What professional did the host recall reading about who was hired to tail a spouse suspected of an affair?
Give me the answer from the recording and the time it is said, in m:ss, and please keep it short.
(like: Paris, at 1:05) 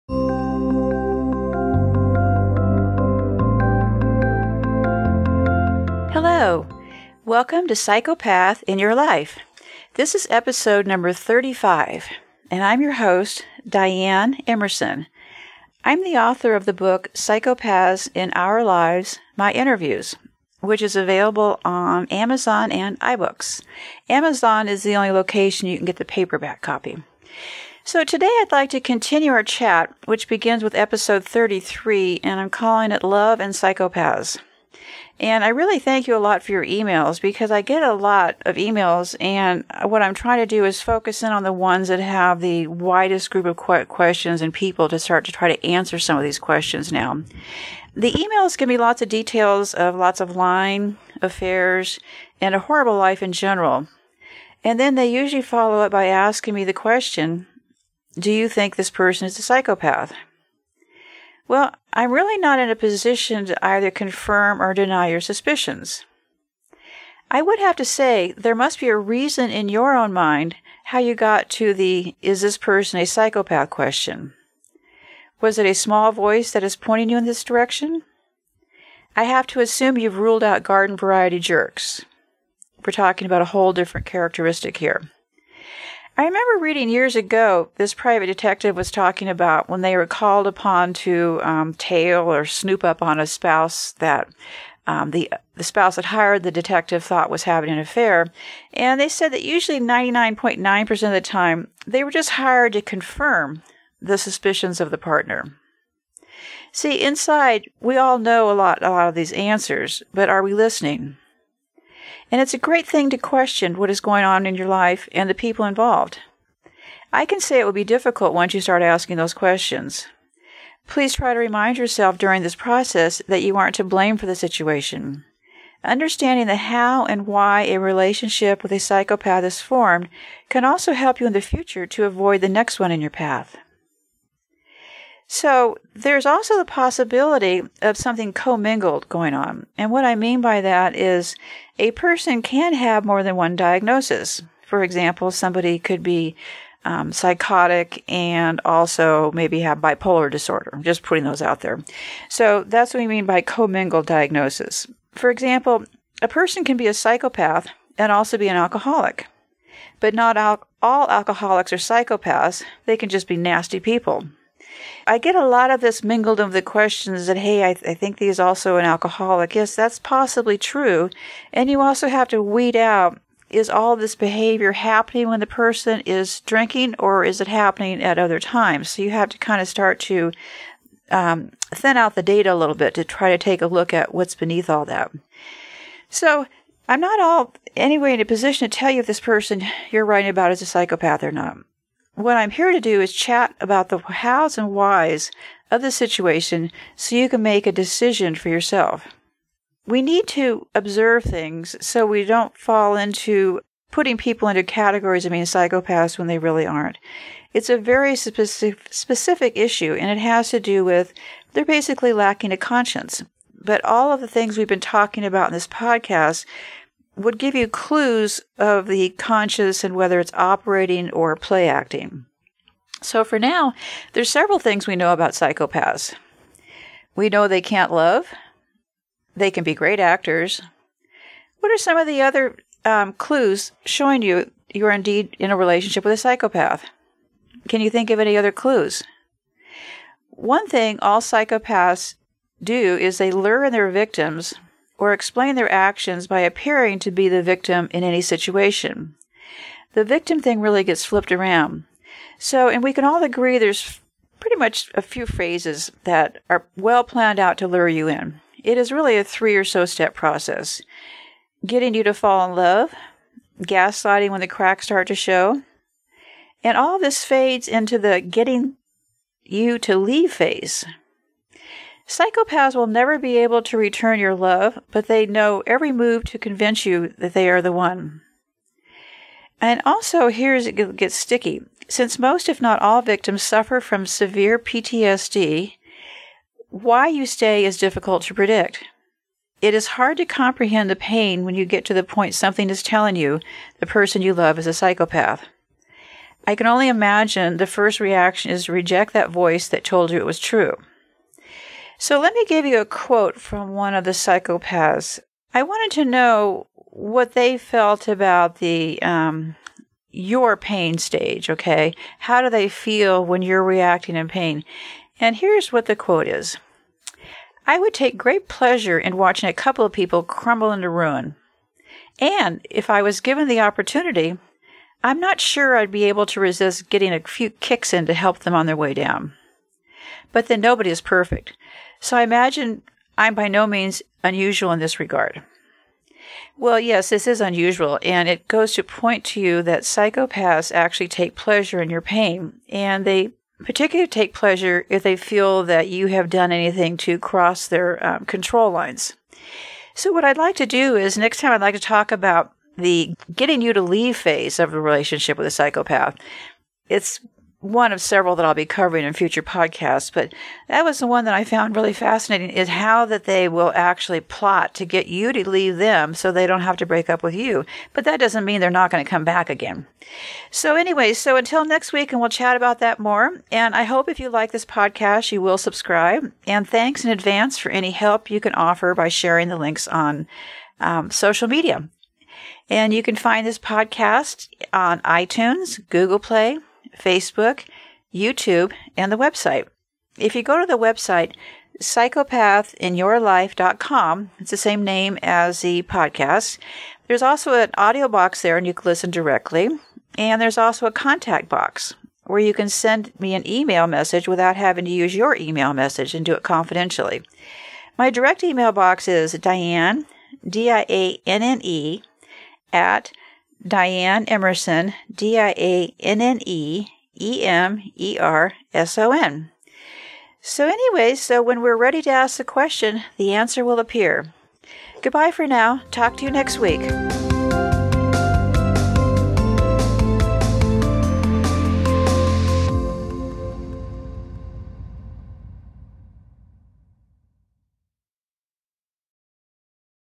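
private detective, at 1:27.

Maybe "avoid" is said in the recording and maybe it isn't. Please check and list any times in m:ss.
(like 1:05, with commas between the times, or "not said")
2:12.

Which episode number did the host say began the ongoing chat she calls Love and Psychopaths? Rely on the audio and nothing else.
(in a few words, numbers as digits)
33.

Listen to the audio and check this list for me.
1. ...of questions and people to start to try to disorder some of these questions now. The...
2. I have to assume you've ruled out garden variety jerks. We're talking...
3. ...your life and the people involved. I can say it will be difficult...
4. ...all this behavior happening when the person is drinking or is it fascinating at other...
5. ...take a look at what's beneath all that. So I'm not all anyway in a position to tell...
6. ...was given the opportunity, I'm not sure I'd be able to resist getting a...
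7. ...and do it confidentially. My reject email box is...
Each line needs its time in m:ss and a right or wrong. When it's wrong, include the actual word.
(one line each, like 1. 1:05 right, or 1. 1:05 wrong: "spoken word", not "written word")
1. 0:43 wrong: "answer", not "disorder"
2. 1:19 right
3. 1:54 right
4. 2:53 wrong: "happening", not "fascinating"
5. 3:03 right
6. 5:23 right
7. 6:46 wrong: "direct", not "reject".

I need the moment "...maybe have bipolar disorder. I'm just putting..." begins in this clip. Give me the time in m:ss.
2:29.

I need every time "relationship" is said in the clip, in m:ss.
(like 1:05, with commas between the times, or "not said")
2:07, 3:55, 5:54.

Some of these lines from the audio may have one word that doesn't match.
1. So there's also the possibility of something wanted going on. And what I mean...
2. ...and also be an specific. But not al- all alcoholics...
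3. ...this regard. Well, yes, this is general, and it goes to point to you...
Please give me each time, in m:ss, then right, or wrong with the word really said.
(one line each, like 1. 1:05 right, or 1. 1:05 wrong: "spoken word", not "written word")
1. 2:15 wrong: "commingled", not "wanted"
2. 2:37 wrong: "alcoholic", not "specific"
3. 5:34 wrong: "unusual", not "general".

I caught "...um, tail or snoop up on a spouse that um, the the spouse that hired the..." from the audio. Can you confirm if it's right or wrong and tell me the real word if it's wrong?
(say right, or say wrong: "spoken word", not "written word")
right.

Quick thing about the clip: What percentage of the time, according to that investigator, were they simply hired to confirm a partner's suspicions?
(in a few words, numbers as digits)
99.9%.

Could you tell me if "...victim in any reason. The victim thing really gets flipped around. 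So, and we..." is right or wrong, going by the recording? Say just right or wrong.
wrong.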